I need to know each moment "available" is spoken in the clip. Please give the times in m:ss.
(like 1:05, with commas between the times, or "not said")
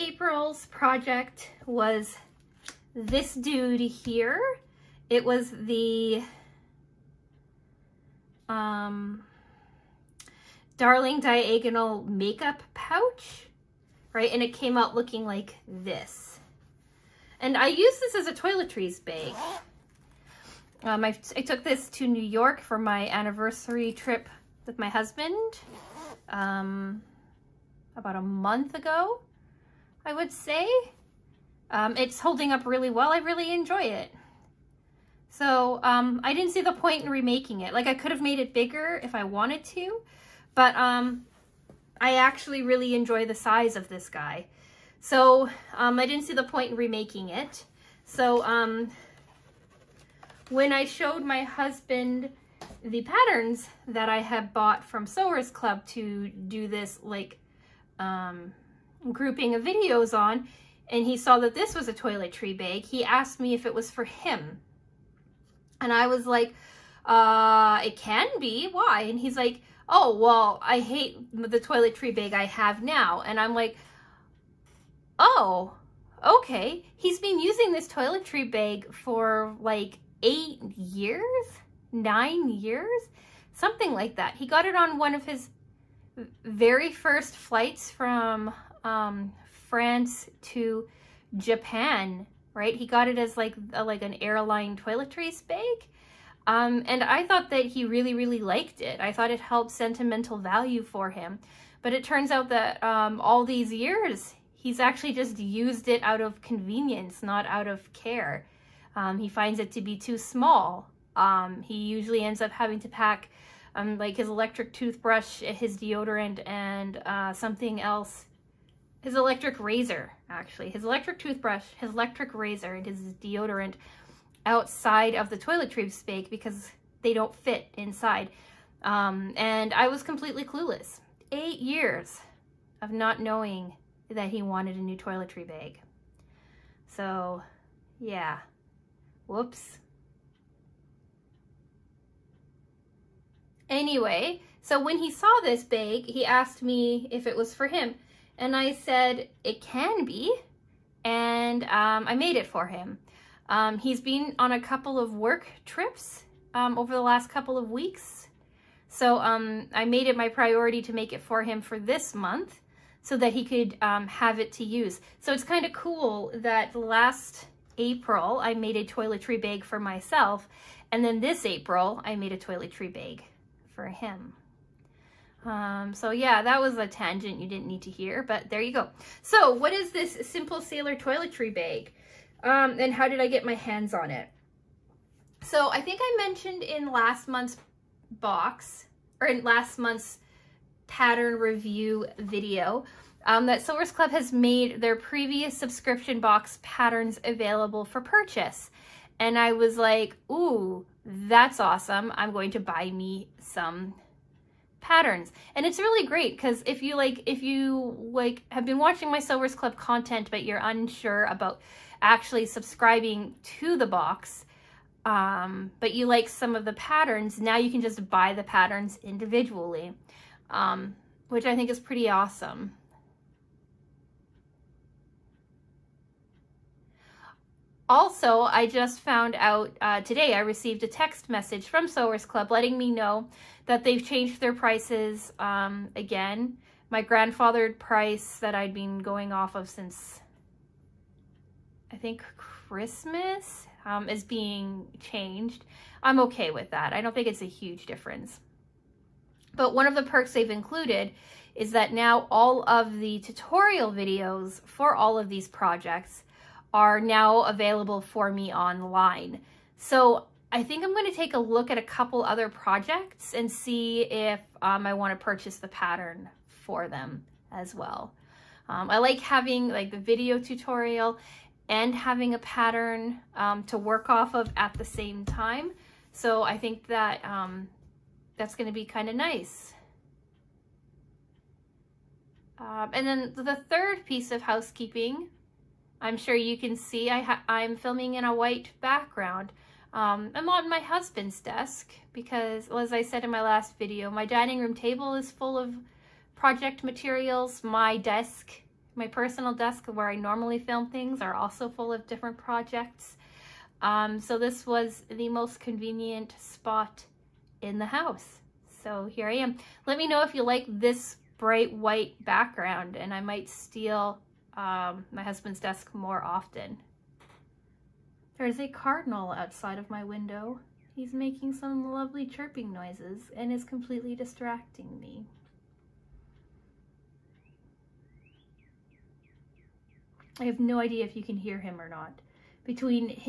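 3:17, 4:17.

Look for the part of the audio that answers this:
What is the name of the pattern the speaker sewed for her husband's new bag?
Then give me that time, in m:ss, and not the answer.
3:00.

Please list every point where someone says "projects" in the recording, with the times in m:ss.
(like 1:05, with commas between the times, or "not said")
0:00, 4:15, 4:22, 4:56, 5:02.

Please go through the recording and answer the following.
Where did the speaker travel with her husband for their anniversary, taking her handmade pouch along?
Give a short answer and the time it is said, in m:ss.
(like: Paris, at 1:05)
New York, at 0:22.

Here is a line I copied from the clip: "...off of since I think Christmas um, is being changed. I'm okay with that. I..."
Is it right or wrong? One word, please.
right.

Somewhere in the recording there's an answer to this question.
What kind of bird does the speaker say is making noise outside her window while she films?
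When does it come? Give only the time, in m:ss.
5:18.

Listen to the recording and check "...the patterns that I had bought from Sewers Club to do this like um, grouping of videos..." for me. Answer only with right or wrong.
right.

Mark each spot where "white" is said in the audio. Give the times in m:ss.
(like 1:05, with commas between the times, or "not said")
4:48, 5:11.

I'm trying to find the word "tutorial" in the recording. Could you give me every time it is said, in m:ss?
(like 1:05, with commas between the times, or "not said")
4:13, 4:30.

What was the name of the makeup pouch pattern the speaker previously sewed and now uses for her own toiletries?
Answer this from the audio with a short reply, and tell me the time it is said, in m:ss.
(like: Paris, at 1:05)
Darling Diagonal, at 0:10.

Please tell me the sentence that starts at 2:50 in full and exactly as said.
And then this April I made a toiletry bag for him.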